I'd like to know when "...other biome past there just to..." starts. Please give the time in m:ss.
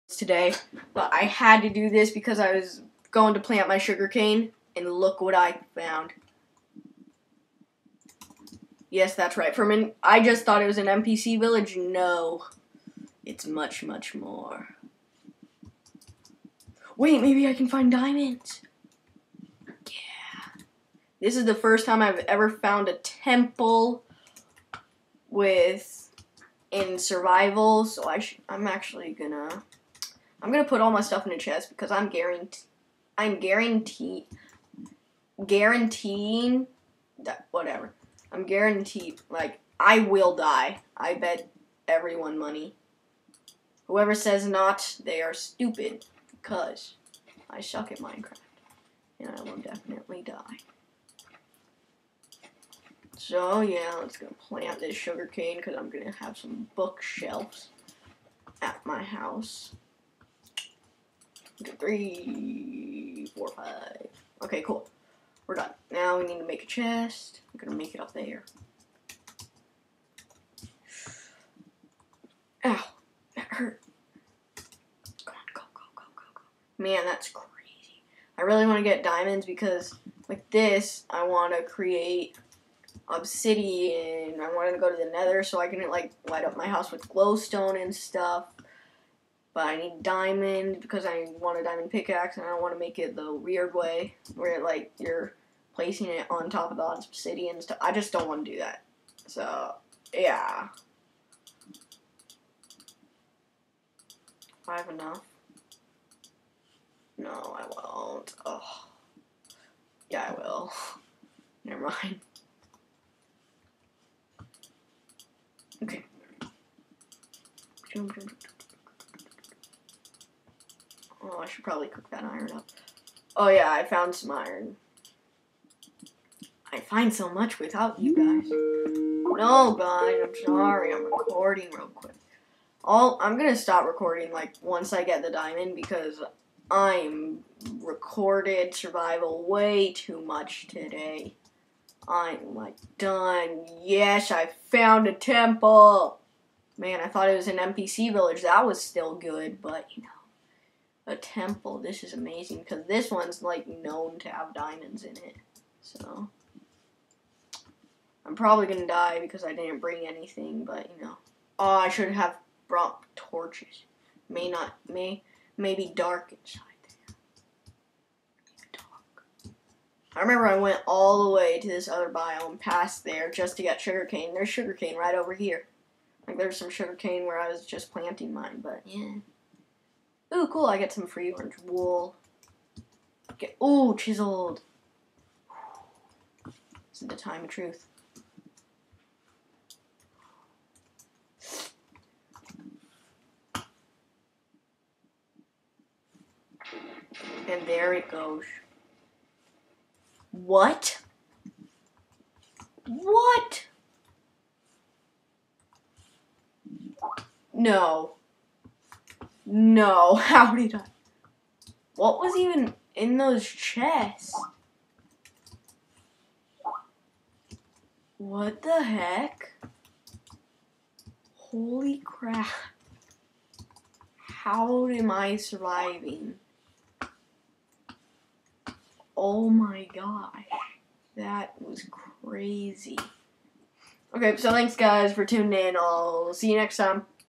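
2:51.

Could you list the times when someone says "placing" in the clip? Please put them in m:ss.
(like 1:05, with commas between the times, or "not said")
1:35.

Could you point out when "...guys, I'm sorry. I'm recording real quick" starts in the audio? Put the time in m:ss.
2:09.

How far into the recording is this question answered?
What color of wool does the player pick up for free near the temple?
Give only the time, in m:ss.
3:01.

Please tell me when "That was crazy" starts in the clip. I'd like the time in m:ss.
3:51.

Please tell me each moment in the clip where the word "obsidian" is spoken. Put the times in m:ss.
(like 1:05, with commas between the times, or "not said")
1:23, 1:36.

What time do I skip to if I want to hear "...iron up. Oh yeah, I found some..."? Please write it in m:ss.
2:02.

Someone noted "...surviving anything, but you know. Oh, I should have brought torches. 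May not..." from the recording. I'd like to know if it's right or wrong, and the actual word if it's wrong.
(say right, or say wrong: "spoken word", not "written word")
wrong: "bring", not "surviving".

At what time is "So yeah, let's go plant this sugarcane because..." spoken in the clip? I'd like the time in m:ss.
0:53.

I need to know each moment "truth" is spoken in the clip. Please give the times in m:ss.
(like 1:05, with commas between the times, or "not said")
3:07.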